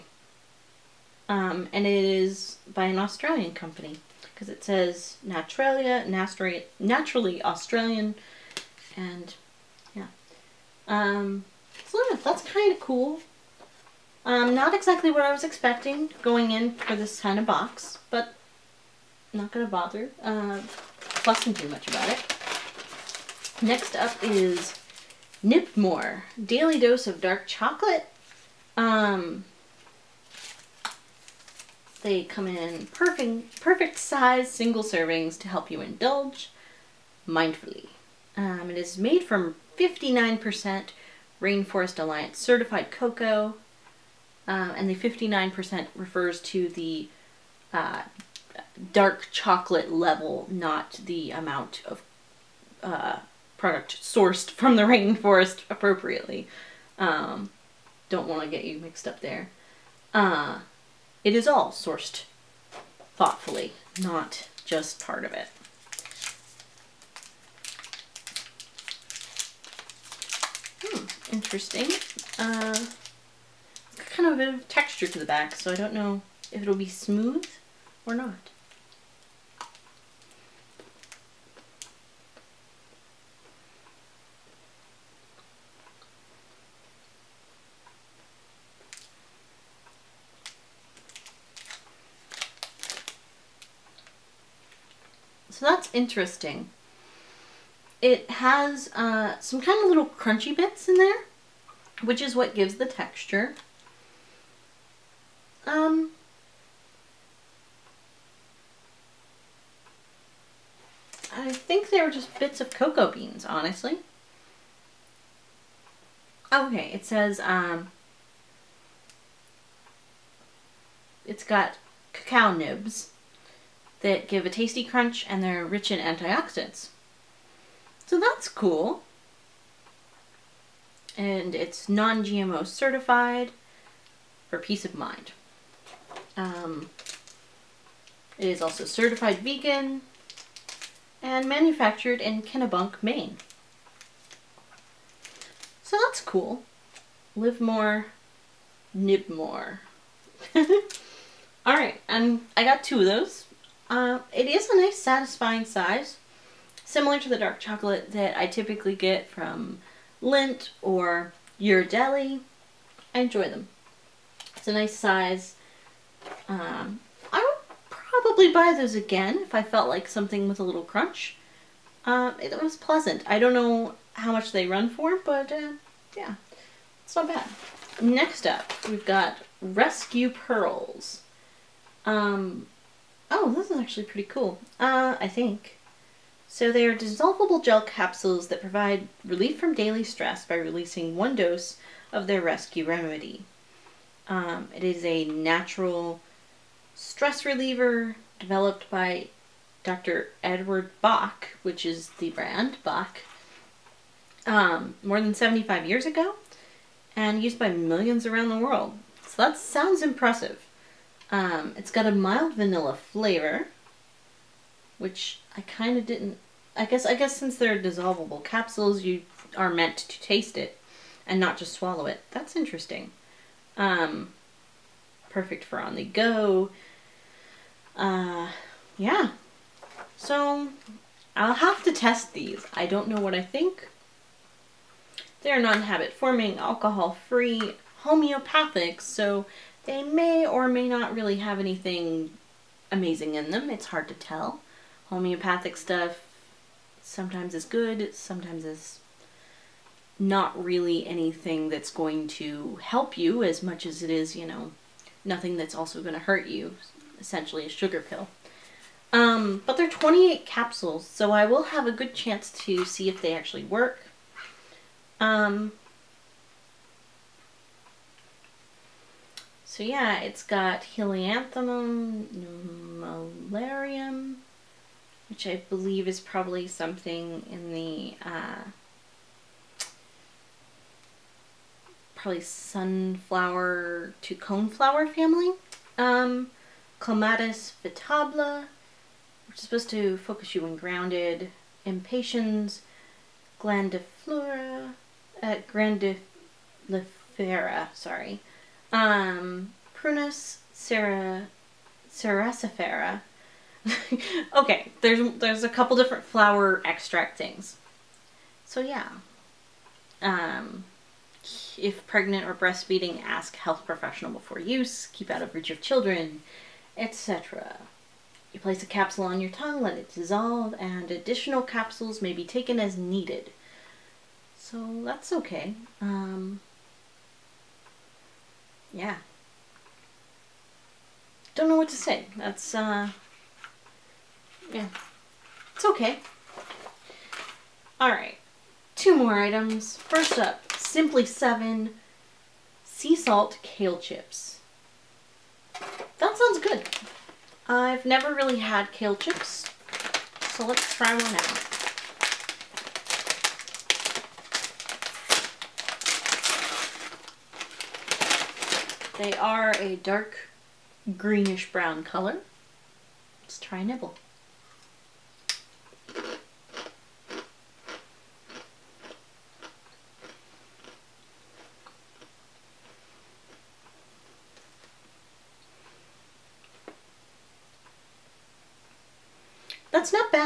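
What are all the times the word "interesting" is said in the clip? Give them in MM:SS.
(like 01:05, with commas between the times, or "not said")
01:11, 01:35, 03:42.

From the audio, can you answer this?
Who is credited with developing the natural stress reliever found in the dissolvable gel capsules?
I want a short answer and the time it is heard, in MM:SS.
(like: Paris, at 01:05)
Dr. Edward Bach, at 03:19.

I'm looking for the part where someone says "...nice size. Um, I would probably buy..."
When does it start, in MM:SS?
02:44.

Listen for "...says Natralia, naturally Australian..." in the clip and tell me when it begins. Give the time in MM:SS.
00:04.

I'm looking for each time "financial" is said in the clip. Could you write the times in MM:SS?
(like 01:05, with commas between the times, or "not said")
not said.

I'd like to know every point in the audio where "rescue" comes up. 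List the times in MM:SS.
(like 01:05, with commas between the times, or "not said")
02:59, 03:12.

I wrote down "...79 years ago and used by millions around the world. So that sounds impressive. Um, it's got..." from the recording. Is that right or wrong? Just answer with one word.
wrong.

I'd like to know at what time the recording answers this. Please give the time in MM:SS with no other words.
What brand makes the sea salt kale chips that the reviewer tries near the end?
05:40.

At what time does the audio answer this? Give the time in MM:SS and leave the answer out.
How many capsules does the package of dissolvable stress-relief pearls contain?
04:19.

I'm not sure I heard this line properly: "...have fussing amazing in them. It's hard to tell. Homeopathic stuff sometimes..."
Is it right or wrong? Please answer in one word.
wrong.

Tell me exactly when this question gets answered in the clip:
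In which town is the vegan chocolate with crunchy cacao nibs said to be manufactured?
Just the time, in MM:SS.
02:22.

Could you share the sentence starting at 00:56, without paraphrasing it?
Um, don't want to get you mixed up there.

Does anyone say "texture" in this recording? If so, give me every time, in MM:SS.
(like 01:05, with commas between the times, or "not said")
01:14, 01:42.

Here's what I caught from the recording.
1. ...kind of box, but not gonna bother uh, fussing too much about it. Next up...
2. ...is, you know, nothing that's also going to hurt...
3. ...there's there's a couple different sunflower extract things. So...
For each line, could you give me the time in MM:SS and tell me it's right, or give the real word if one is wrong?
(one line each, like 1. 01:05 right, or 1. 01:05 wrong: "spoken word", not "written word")
1. 00:17 right
2. 04:14 right
3. 05:05 wrong: "flower", not "sunflower".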